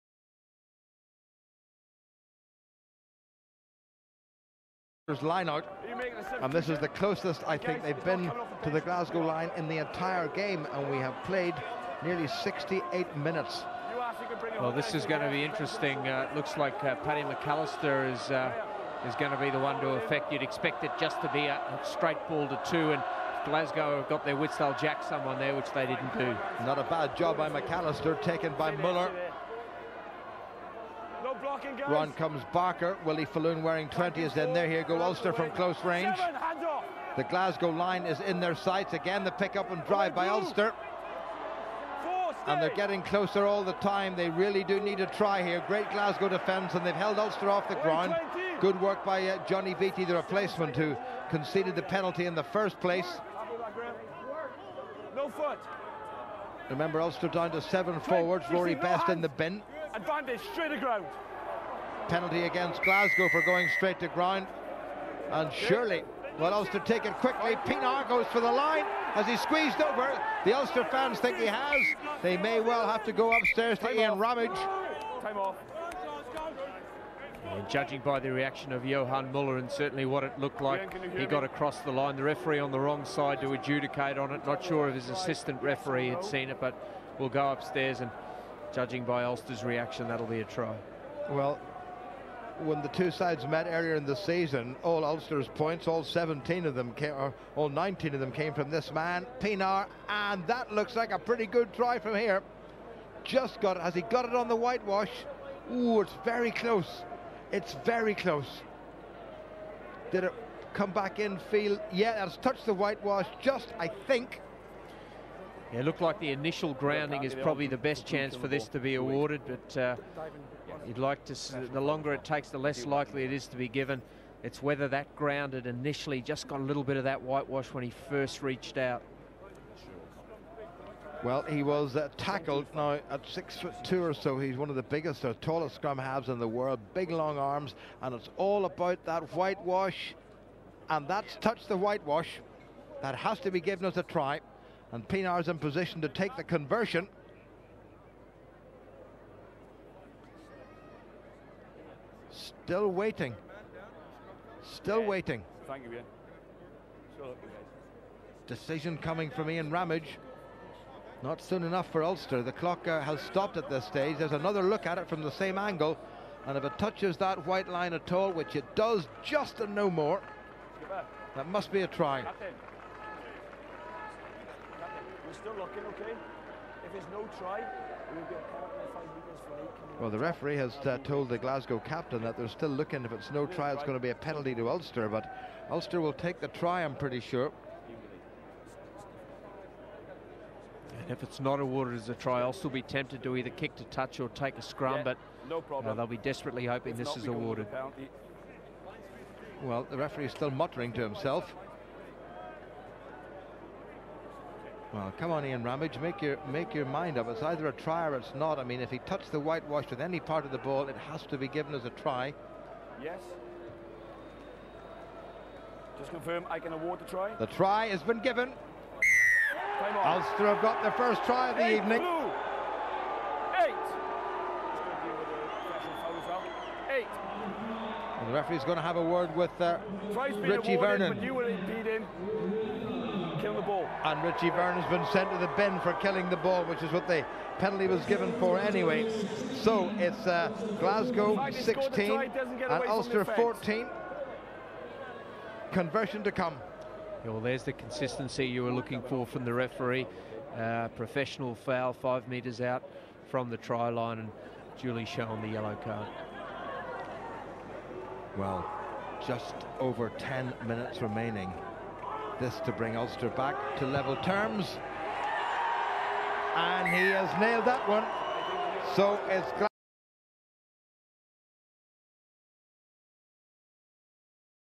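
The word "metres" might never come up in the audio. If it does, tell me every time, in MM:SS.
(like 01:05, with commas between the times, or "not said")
02:59, 04:12.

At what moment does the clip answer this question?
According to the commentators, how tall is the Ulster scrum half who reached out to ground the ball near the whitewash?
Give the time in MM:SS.
02:13.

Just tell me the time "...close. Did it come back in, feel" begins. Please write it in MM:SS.
01:48.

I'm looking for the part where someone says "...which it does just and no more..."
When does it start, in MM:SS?
02:48.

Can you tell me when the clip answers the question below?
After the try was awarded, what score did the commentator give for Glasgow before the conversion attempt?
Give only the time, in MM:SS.
04:00.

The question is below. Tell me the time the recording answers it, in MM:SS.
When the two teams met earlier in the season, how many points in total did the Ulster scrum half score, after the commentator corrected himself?
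01:37.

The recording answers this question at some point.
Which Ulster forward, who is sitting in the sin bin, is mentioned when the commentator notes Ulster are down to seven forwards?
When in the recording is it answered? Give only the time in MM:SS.
00:58.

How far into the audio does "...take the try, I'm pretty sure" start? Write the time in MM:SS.
03:06.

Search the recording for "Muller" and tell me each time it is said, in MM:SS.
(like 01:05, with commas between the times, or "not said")
00:28, 01:19.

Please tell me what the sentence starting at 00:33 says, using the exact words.
Willie Faloon wearing 20 is in there.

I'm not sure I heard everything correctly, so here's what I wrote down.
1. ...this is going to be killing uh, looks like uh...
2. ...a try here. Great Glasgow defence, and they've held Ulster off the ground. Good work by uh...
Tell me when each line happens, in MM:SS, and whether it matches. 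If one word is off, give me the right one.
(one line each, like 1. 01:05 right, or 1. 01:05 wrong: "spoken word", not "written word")
1. 00:14 wrong: "interesting", not "killing"
2. 00:45 right.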